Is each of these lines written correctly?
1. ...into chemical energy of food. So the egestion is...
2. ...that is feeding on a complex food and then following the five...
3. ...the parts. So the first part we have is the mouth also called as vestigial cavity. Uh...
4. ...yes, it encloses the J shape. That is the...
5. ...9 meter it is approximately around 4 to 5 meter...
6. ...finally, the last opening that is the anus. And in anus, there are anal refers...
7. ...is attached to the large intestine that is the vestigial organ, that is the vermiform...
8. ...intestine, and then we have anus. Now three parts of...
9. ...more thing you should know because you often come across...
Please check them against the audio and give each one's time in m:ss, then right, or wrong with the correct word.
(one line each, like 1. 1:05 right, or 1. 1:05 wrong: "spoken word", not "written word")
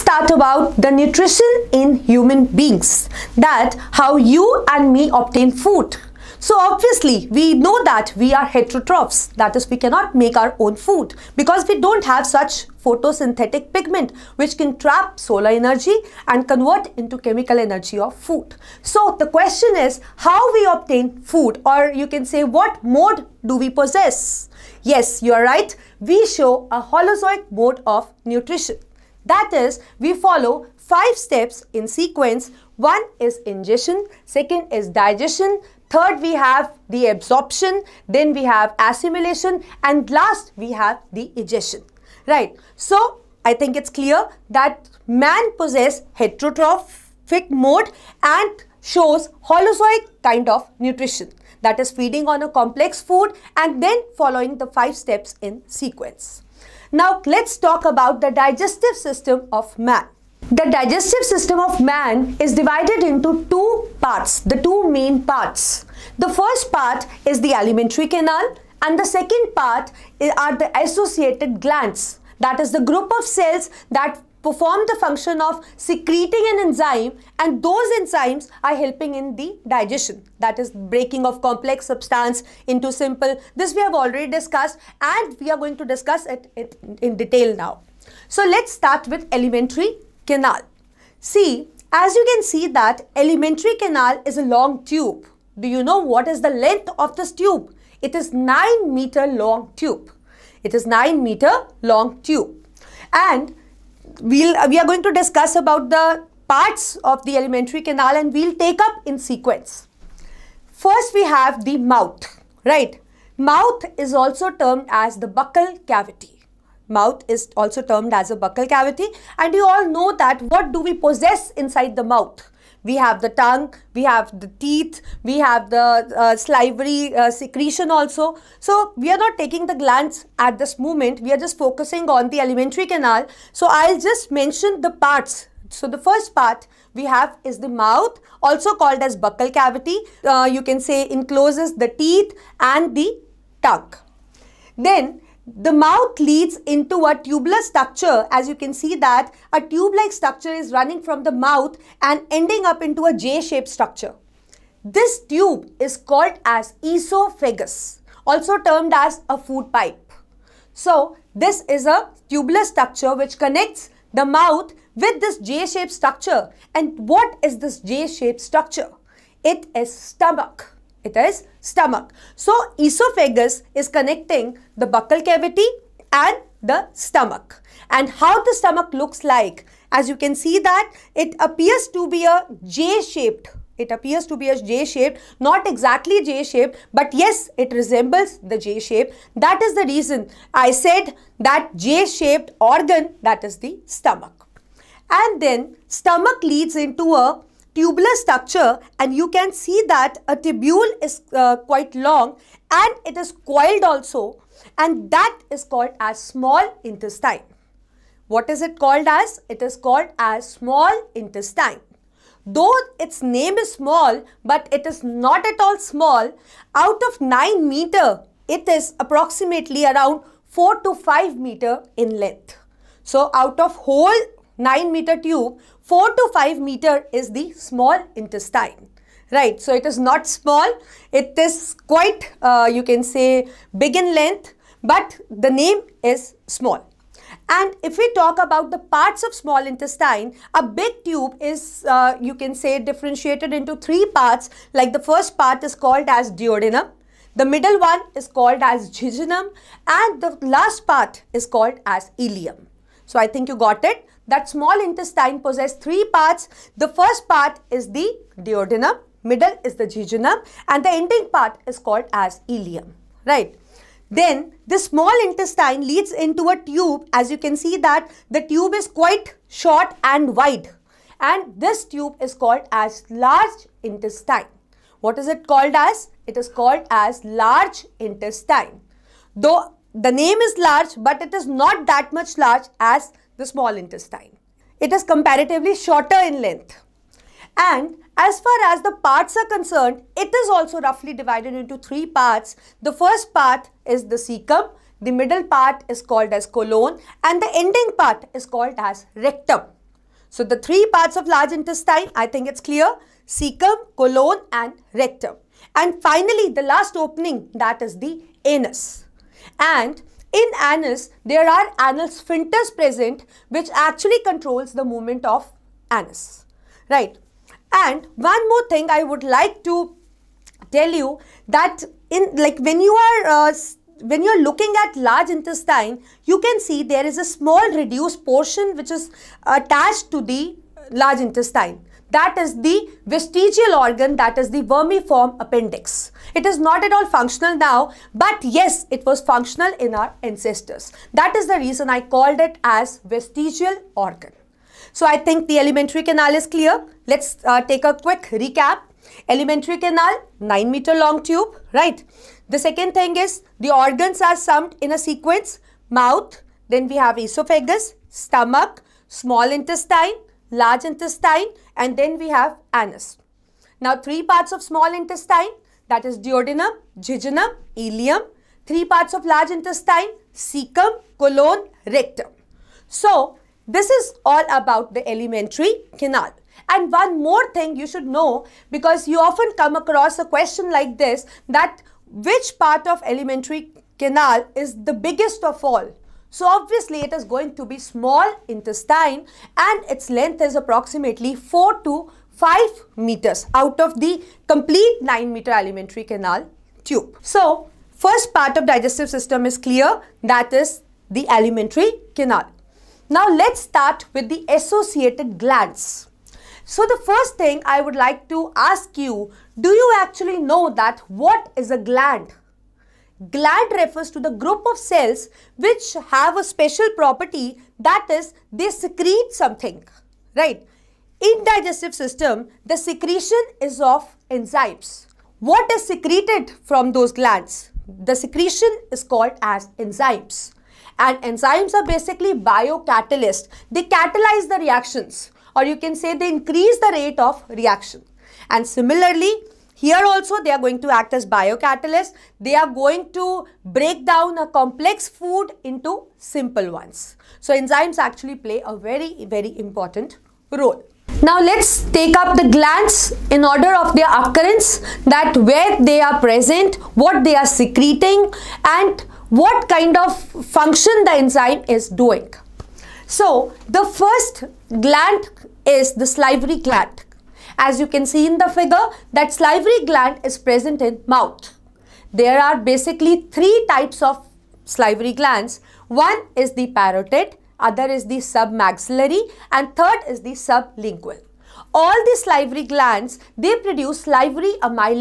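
1. 0:16 wrong: "question", not "egestion"
2. 0:51 right
3. 2:14 wrong: "buccal", not "vestigial"
4. 3:07 wrong: "resembles", not "encloses"
5. 3:37 right
6. 5:06 wrong: "sphincters", not "refers"
7. 5:28 right
8. 6:00 right
9. 6:17 right.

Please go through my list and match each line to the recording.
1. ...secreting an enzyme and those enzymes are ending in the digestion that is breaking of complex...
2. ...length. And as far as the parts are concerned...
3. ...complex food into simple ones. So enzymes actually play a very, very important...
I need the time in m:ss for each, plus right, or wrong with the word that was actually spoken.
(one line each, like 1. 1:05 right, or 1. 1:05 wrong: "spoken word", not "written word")
1. 1:15 wrong: "helping", not "ending"
2. 4:46 right
3. 7:24 right.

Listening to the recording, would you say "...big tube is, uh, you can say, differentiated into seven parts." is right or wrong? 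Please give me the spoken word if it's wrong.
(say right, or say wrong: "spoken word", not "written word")
wrong: "three", not "seven".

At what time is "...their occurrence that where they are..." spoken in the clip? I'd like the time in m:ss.
7:33.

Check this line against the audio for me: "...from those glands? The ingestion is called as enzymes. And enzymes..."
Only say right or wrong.
wrong.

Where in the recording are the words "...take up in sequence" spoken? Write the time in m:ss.
1:48.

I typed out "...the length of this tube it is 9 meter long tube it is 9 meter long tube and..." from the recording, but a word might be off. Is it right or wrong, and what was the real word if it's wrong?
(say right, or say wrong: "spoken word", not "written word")
right.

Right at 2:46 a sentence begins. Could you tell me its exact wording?
And what is this J-shaped structure?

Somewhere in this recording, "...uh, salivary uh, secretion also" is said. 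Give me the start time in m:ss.
2:06.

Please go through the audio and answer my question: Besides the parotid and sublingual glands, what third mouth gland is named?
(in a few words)
Submaxillary.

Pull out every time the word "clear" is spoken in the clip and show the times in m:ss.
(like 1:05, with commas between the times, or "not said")
0:43, 5:02, 5:46, 6:39.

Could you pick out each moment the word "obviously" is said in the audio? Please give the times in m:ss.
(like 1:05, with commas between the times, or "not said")
0:06, 6:26.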